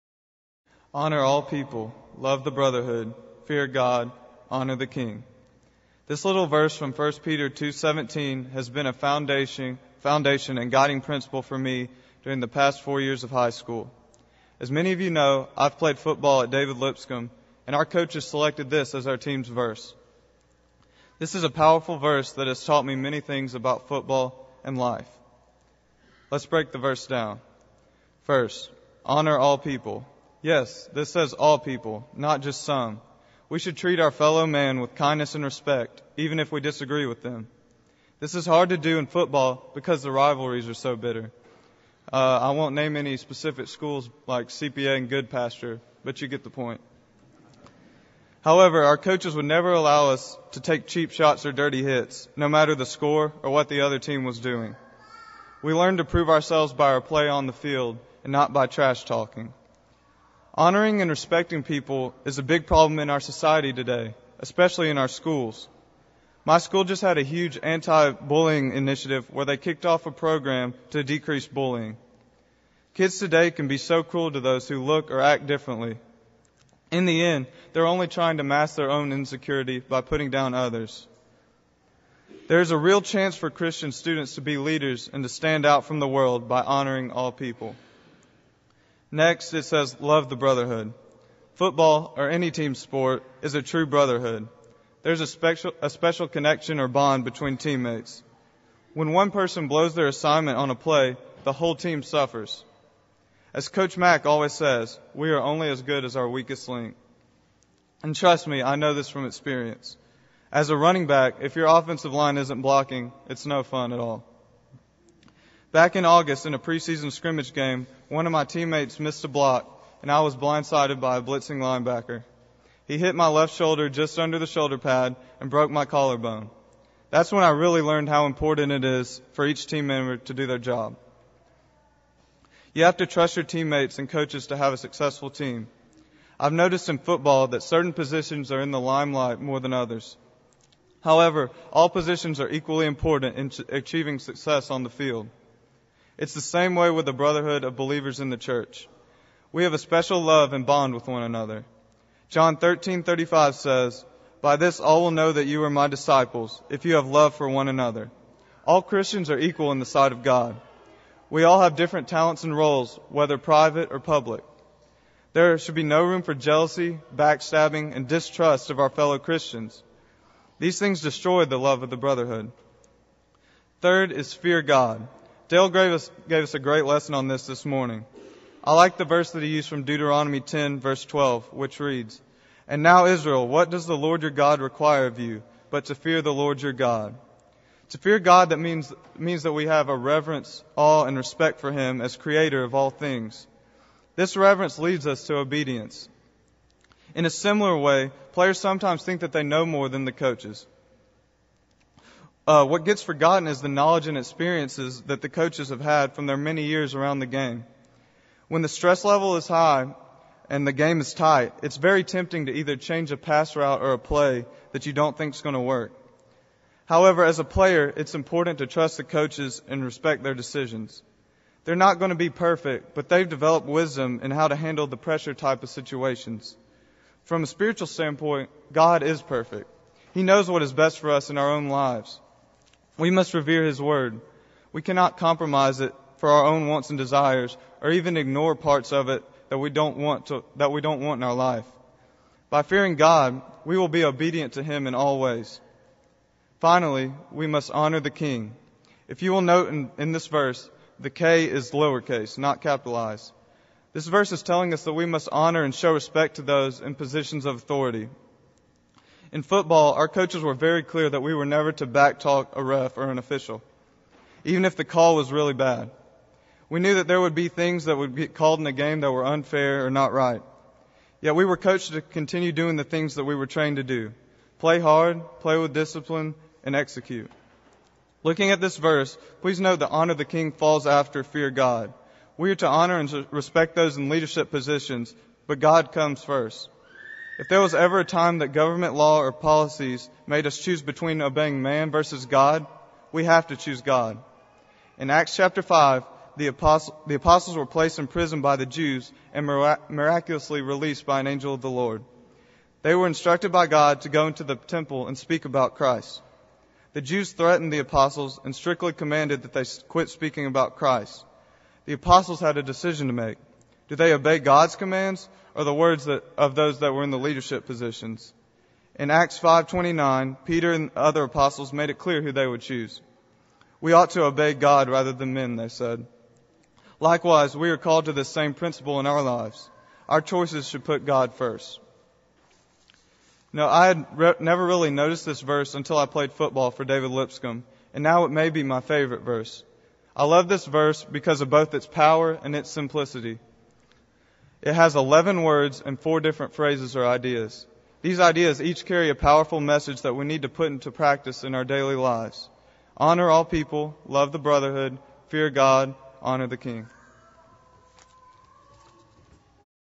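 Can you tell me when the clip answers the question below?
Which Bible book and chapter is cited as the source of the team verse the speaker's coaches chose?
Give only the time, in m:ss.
0:06.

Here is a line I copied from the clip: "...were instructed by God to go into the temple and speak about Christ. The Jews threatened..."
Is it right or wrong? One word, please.
right.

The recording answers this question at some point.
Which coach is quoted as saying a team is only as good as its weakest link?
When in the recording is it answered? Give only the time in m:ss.
1:43.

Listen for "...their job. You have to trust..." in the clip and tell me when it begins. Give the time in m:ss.
2:10.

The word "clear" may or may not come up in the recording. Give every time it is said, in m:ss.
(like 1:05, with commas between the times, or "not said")
4:20, 5:21.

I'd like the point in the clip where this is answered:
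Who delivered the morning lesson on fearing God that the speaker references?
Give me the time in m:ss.
2:55.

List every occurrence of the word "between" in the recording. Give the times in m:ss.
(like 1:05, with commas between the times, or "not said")
1:37, 4:50.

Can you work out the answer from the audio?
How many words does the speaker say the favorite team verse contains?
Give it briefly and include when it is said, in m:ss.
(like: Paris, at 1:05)
11, at 5:44.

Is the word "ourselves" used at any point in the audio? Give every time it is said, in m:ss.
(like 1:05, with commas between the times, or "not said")
0:56.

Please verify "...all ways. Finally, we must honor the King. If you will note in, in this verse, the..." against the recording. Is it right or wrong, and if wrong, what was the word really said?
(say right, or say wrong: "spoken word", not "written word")
right.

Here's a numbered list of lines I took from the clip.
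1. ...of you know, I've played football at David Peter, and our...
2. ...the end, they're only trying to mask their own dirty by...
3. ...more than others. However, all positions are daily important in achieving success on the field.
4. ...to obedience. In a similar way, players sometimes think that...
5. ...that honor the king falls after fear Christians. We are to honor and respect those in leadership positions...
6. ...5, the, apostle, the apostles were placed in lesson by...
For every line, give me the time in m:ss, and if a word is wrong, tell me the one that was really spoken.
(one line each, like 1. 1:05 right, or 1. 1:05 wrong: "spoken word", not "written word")
1. 0:14 wrong: "Lipscomb", not "Peter"
2. 1:17 wrong: "insecurity", not "dirty"
3. 2:19 wrong: "equally", not "daily"
4. 3:15 right
5. 4:39 wrong: "God", not "Christians"
6. 4:55 wrong: "prison", not "lesson".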